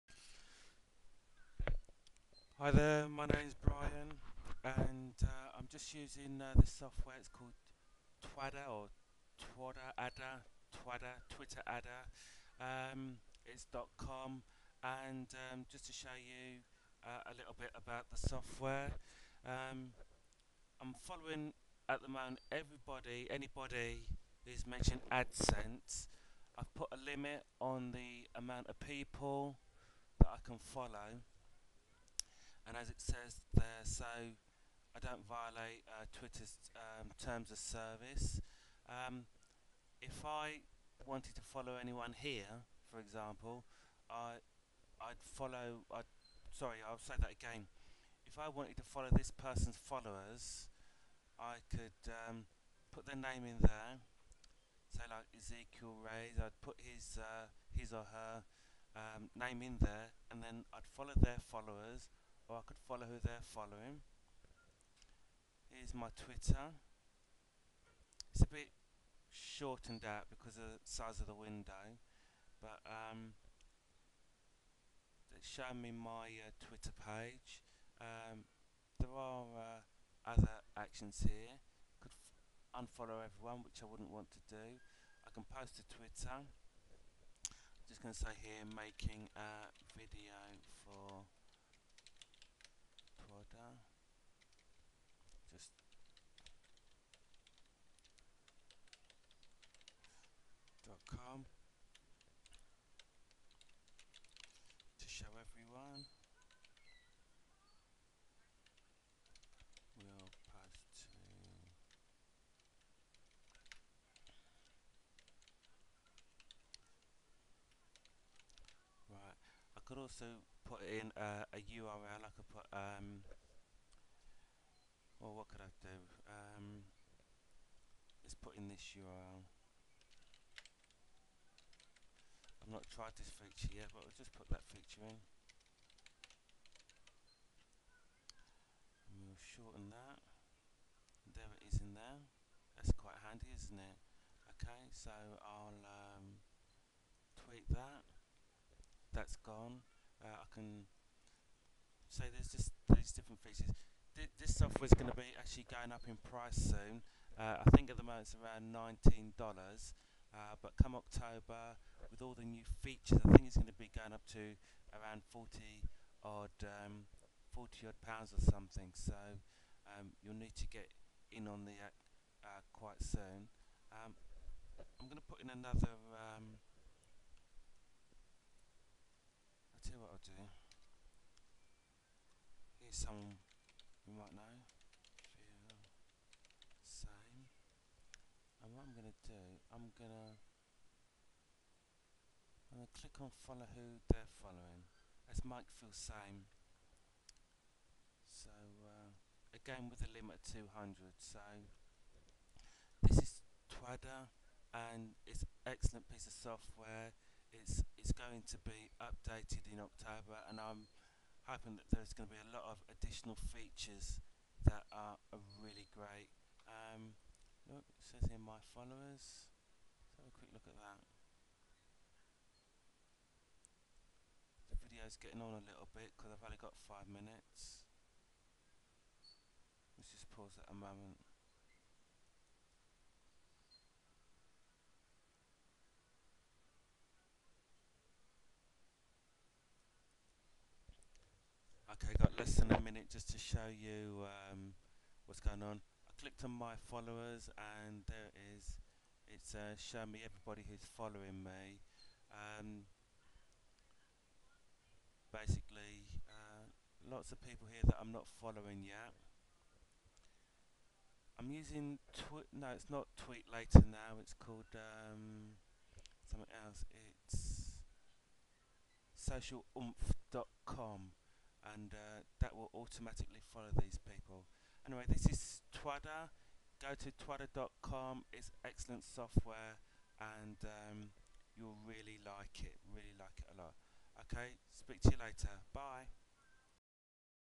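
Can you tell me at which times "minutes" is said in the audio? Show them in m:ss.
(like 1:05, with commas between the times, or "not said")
3:47, 4:02.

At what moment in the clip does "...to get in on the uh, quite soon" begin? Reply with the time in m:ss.
2:50.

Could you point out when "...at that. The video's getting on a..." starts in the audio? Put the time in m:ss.
3:40.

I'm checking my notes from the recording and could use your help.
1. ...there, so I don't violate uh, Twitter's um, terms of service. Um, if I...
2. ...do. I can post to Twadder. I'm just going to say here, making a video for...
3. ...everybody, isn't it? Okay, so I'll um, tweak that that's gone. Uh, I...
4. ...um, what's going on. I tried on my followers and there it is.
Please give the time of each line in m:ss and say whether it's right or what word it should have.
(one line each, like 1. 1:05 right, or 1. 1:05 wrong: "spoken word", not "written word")
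1. 0:33 right
2. 1:24 wrong: "Twitter", not "Twadder"
3. 2:23 wrong: "handy", not "everybody"
4. 4:04 wrong: "clicked", not "tried".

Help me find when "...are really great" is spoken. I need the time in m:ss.
3:35.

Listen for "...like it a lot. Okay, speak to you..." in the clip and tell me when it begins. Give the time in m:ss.
4:43.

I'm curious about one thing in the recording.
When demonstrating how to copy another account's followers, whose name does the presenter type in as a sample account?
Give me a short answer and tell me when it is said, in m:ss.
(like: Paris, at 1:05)
Ezekiel Reyes, at 0:55.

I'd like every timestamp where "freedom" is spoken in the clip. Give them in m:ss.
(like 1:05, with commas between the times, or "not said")
not said.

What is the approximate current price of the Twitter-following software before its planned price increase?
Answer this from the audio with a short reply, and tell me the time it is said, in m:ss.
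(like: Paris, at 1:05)
$19, at 2:38.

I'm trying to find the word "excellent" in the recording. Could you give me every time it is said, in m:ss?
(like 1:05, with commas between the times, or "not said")
3:25, 4:38.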